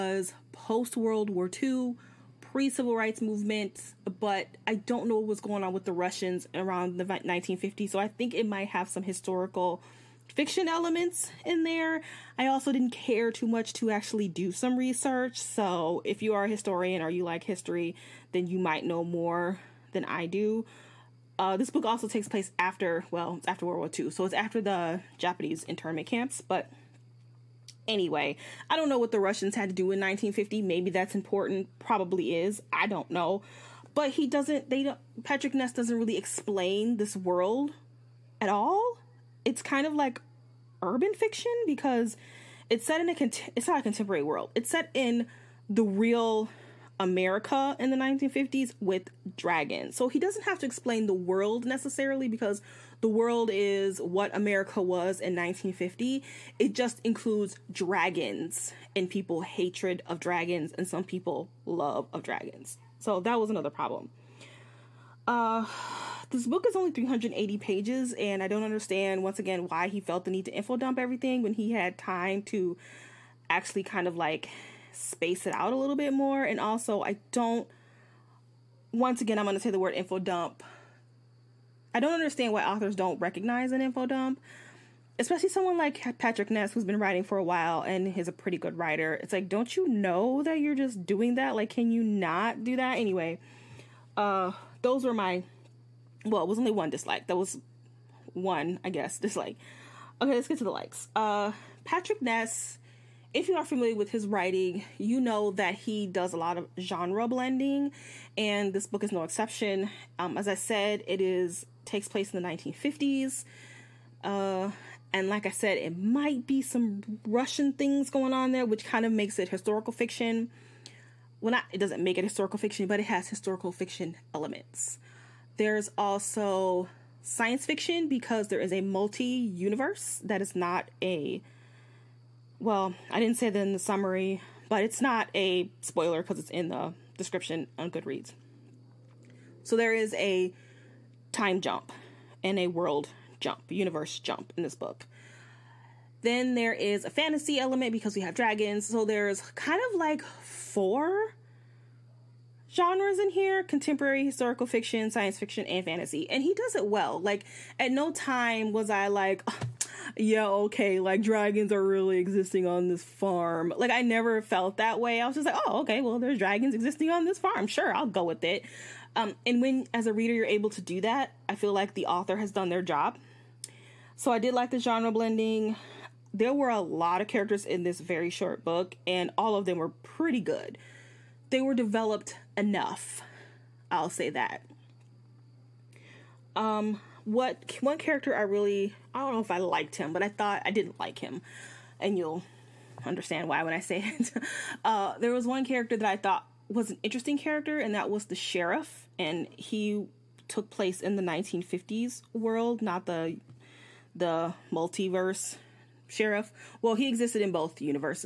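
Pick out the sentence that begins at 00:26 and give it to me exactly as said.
But anyway, I don't know what the Russians had to do in 1950.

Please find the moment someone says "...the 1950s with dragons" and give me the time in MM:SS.
00:47.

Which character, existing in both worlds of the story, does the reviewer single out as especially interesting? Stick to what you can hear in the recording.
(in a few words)
The sheriff.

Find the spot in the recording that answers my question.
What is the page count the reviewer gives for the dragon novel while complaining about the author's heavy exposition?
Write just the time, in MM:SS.
01:06.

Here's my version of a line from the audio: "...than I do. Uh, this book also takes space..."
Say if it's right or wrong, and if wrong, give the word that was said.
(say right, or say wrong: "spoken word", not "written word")
wrong: "place", not "space".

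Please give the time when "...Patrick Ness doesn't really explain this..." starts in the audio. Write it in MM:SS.
00:35.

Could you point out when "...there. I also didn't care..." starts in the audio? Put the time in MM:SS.
00:11.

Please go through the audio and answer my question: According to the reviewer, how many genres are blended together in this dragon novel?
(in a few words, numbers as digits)
4.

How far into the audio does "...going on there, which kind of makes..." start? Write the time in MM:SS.
01:58.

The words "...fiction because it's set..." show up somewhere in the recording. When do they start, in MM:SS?
00:41.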